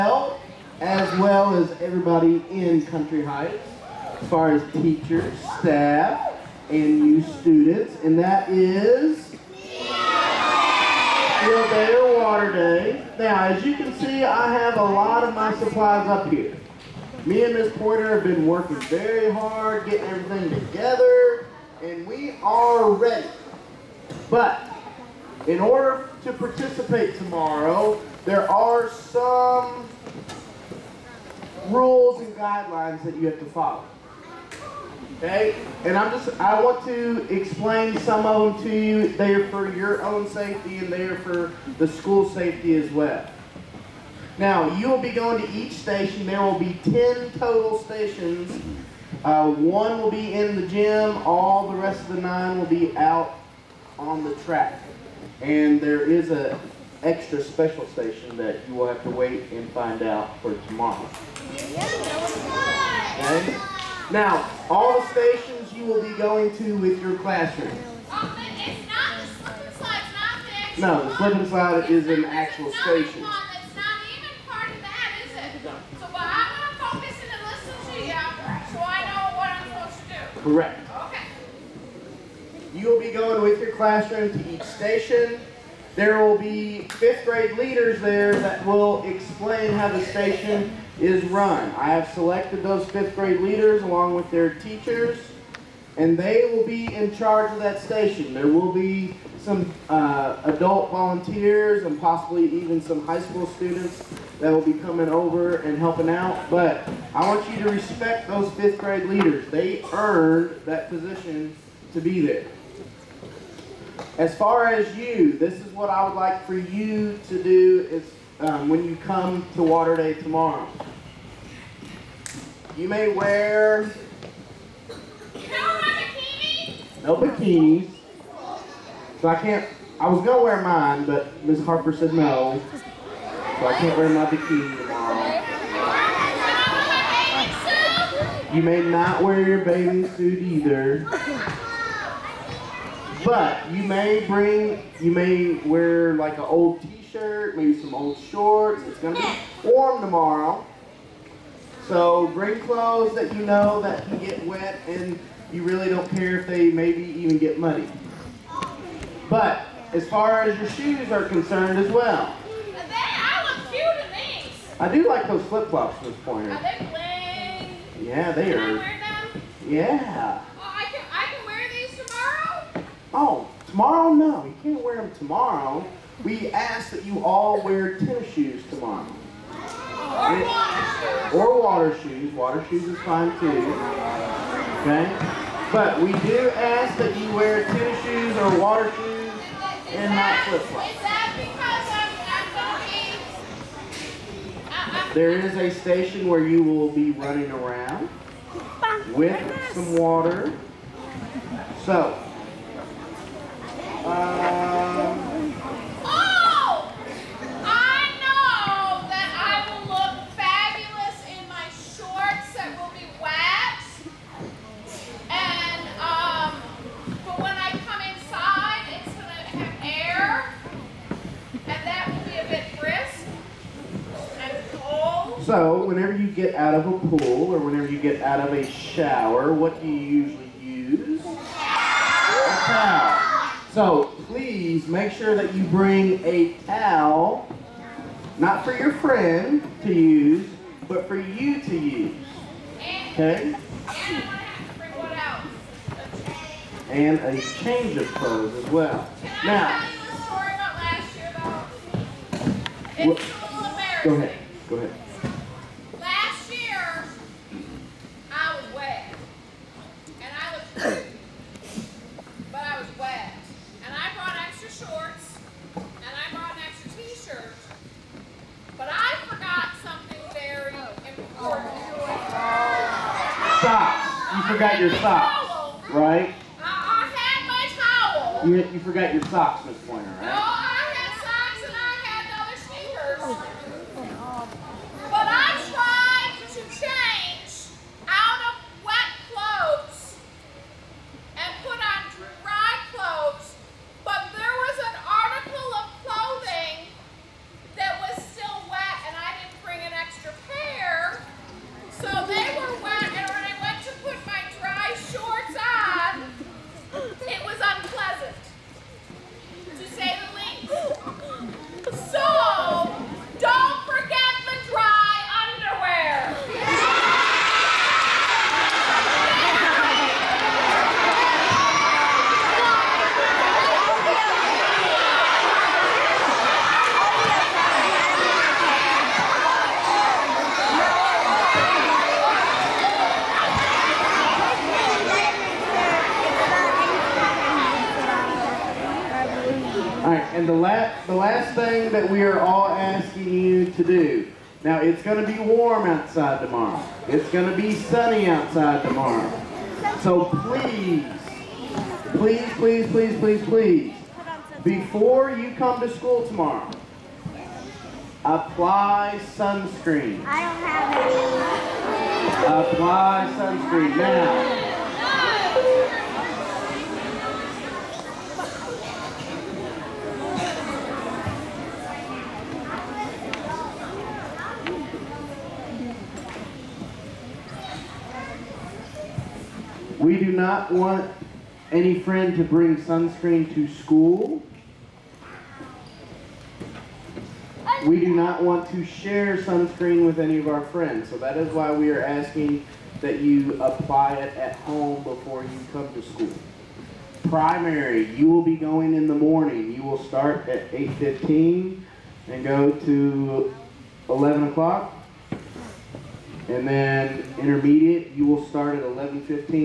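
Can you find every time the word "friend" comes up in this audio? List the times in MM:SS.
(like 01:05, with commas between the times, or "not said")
03:58, 06:22, 06:30.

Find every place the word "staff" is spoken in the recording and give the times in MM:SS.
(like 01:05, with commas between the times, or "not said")
00:05.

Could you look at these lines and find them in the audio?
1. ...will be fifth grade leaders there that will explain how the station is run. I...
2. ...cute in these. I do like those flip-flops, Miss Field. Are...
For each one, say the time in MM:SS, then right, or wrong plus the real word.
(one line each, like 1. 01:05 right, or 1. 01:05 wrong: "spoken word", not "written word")
1. 01:26 right
2. 02:43 wrong: "Pointer", not "Field".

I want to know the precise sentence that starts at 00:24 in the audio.
But in order to participate tomorrow, there are some rules and guidelines that you have to follow.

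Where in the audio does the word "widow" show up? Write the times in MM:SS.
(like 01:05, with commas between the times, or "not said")
not said.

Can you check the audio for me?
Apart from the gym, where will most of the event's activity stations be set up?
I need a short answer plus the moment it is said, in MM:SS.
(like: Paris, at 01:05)
the track, at 00:52.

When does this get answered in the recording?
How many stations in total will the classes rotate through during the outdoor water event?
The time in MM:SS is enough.
00:46.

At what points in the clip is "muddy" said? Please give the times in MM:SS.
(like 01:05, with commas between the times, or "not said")
02:37.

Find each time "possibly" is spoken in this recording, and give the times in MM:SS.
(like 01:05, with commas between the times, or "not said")
01:42.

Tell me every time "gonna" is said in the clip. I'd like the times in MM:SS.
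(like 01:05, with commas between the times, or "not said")
02:10, 02:28.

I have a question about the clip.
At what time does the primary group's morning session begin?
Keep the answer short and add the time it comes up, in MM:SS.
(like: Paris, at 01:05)
8:15, at 06:40.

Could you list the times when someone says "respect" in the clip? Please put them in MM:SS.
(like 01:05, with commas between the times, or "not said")
01:47.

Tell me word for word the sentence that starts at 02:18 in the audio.
You may not wear your bathing suit either.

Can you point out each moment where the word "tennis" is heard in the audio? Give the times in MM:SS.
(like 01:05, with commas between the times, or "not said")
02:57, 03:07.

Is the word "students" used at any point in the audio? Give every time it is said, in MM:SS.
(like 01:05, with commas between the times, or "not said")
00:07, 01:43.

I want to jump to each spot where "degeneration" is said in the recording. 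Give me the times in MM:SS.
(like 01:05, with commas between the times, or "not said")
not said.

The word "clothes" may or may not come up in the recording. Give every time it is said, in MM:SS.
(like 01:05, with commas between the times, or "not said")
02:32, 04:08.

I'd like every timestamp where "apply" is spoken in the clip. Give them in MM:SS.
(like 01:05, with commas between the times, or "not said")
05:58, 06:02, 06:33.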